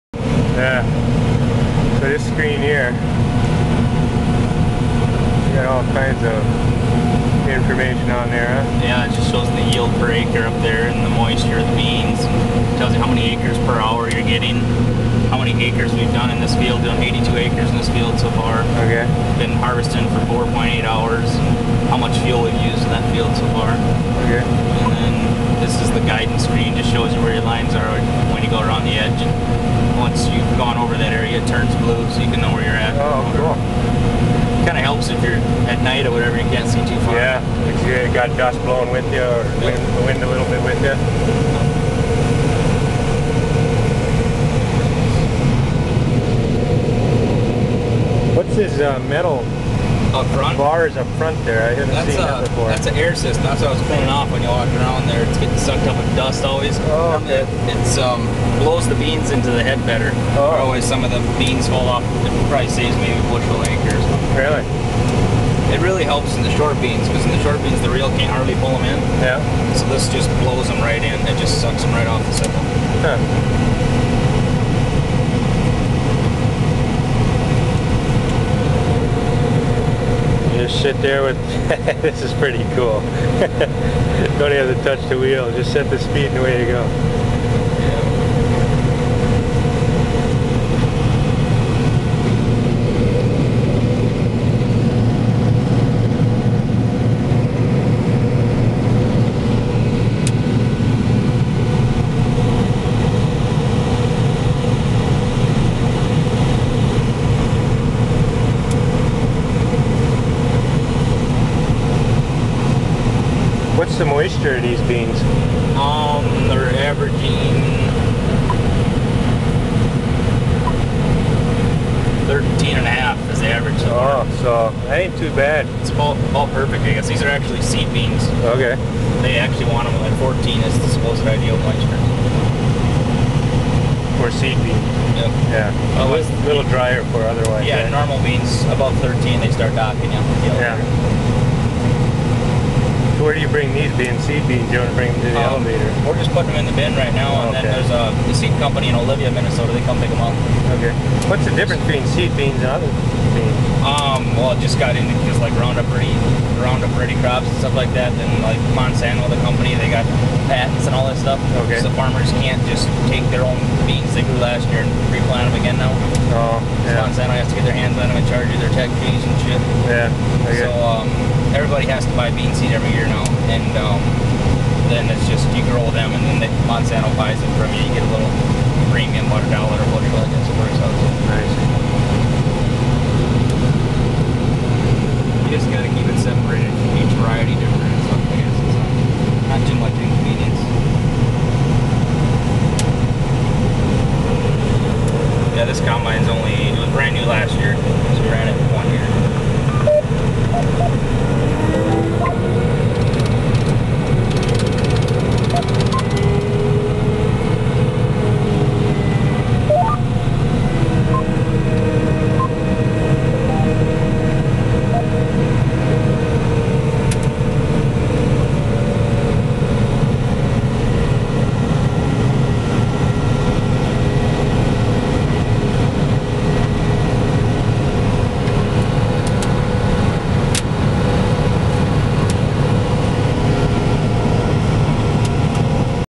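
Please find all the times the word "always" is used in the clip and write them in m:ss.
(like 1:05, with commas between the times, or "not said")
0:56, 1:00.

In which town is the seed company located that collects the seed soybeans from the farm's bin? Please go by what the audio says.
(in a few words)
Olivia, Minnesota.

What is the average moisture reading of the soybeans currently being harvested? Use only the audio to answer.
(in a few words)
13.5.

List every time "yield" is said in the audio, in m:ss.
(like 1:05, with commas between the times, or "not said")
0:09.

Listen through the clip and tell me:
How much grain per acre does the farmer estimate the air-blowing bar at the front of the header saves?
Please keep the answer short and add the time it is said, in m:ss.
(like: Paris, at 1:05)
a bushel, at 1:03.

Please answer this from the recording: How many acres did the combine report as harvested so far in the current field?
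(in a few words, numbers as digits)
82.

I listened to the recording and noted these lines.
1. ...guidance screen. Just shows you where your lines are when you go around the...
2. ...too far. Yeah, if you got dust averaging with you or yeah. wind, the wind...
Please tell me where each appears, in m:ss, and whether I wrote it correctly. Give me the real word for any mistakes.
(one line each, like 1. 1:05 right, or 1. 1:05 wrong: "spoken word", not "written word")
1. 0:26 right
2. 0:36 wrong: "blowing", not "averaging".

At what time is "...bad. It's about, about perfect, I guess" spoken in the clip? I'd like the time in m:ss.
2:05.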